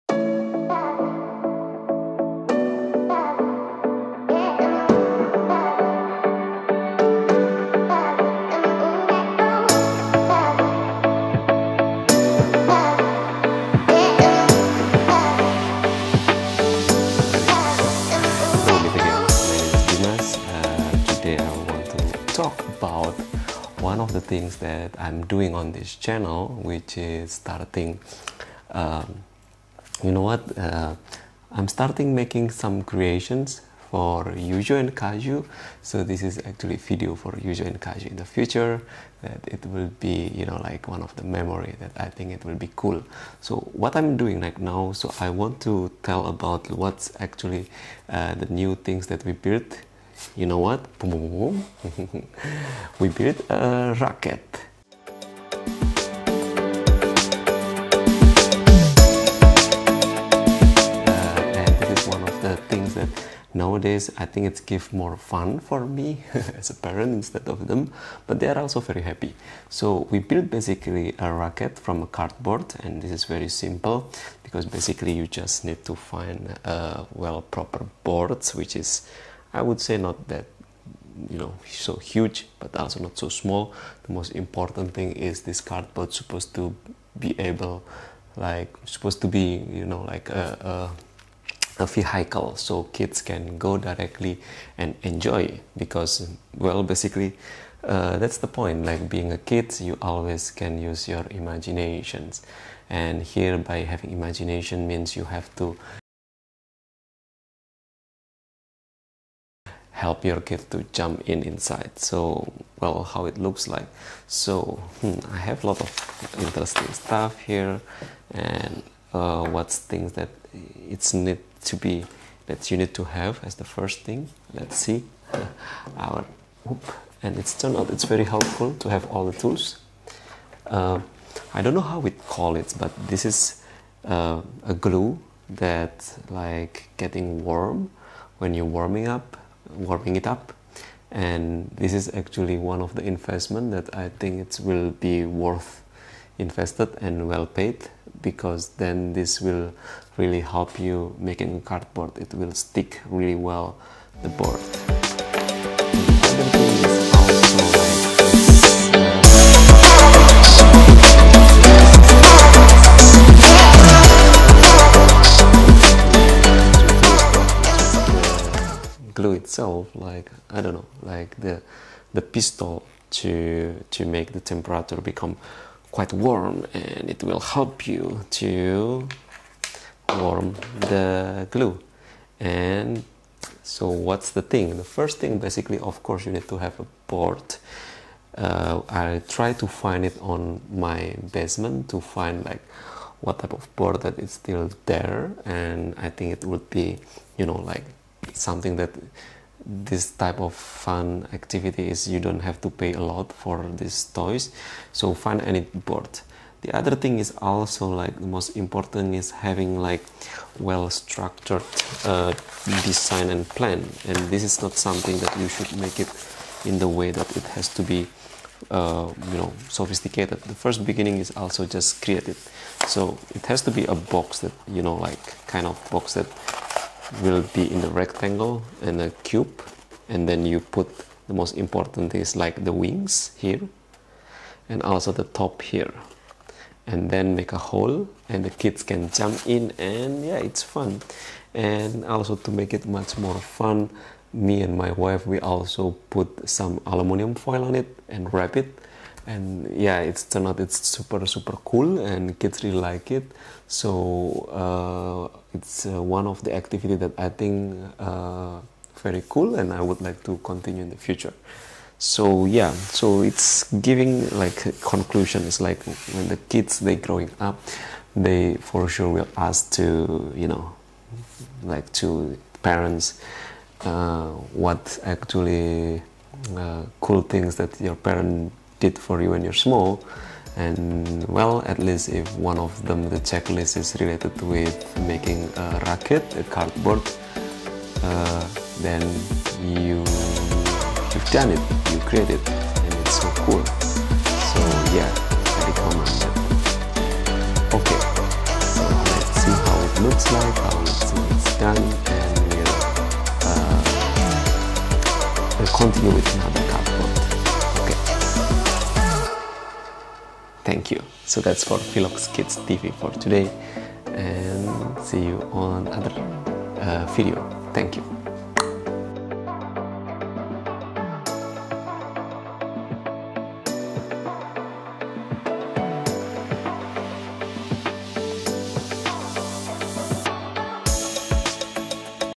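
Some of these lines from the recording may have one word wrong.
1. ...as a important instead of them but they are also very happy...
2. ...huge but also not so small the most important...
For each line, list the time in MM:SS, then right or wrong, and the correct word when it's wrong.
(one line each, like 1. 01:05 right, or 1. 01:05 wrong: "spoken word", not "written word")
1. 01:06 wrong: "parent", not "important"
2. 01:21 right.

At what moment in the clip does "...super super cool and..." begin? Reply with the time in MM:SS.
04:10.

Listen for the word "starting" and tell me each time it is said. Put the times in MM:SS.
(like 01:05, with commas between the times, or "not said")
00:27, 00:31.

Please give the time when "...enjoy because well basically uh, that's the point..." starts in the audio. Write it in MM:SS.
01:35.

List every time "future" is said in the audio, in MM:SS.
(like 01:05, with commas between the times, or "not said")
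00:38, 04:20.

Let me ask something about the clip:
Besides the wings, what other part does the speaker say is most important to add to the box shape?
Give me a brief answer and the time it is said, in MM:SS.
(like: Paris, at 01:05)
The top, at 03:55.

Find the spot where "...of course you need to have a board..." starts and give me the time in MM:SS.
03:05.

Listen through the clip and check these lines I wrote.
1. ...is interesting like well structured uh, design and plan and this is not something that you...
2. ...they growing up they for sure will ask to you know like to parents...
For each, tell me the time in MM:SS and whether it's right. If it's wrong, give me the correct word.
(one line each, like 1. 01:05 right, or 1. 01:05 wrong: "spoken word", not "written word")
1. 03:29 wrong: "having", not "interesting"
2. 04:26 right.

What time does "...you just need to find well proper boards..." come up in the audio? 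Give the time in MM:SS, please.
01:15.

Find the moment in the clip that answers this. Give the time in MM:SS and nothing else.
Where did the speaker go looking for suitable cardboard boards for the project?
03:11.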